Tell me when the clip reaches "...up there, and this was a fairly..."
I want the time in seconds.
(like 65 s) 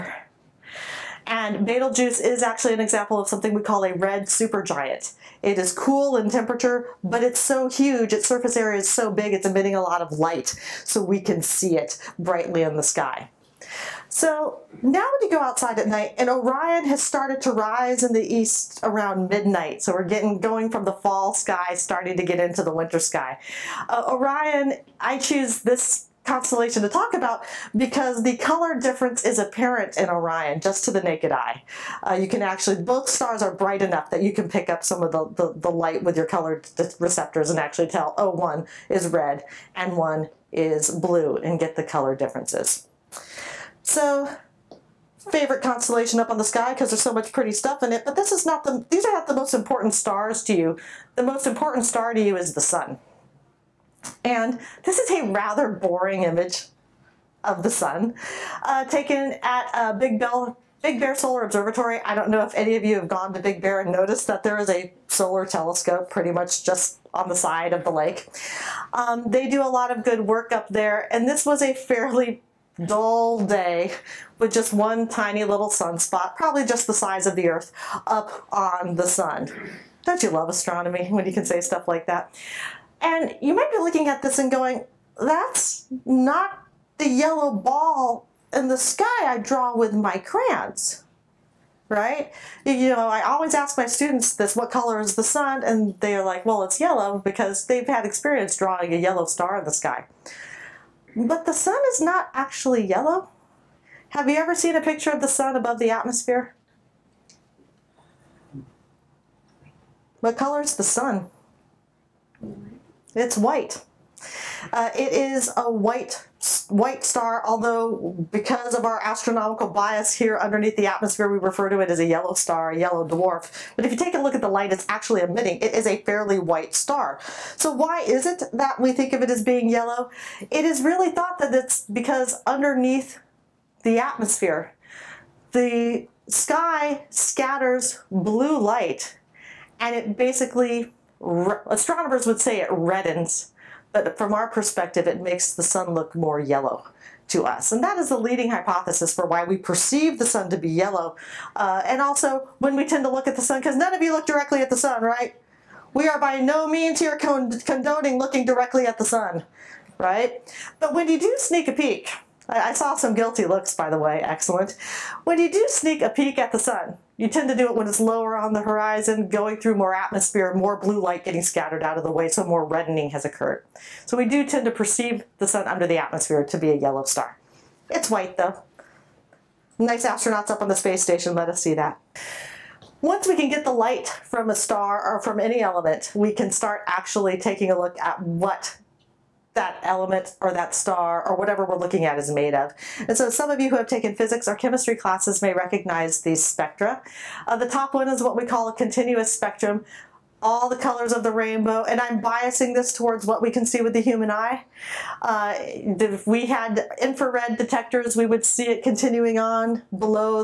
70 s.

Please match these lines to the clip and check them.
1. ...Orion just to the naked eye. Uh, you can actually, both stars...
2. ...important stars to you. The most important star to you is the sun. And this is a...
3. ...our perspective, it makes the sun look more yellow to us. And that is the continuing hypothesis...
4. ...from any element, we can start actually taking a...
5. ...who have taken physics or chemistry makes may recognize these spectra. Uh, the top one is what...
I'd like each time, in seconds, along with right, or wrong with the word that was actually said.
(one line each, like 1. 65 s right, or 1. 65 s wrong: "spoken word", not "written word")
1. 30 s right
2. 49 s right
3. 144 s wrong: "leading", not "continuing"
4. 185 s right
5. 193 s wrong: "classes", not "makes".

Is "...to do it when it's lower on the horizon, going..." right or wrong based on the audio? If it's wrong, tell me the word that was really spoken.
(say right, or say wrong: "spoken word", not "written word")
right.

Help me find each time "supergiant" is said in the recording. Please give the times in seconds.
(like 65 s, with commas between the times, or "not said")
4 s.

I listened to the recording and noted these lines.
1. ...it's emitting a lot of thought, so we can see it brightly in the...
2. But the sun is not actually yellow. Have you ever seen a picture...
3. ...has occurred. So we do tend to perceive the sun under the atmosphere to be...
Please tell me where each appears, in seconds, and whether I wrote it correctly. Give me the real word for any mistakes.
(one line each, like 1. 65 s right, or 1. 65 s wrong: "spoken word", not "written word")
1. 9 s wrong: "light", not "thought"
2. 101 s right
3. 173 s right.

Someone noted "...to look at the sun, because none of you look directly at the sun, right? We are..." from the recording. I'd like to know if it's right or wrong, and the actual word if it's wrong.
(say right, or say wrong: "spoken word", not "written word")
right.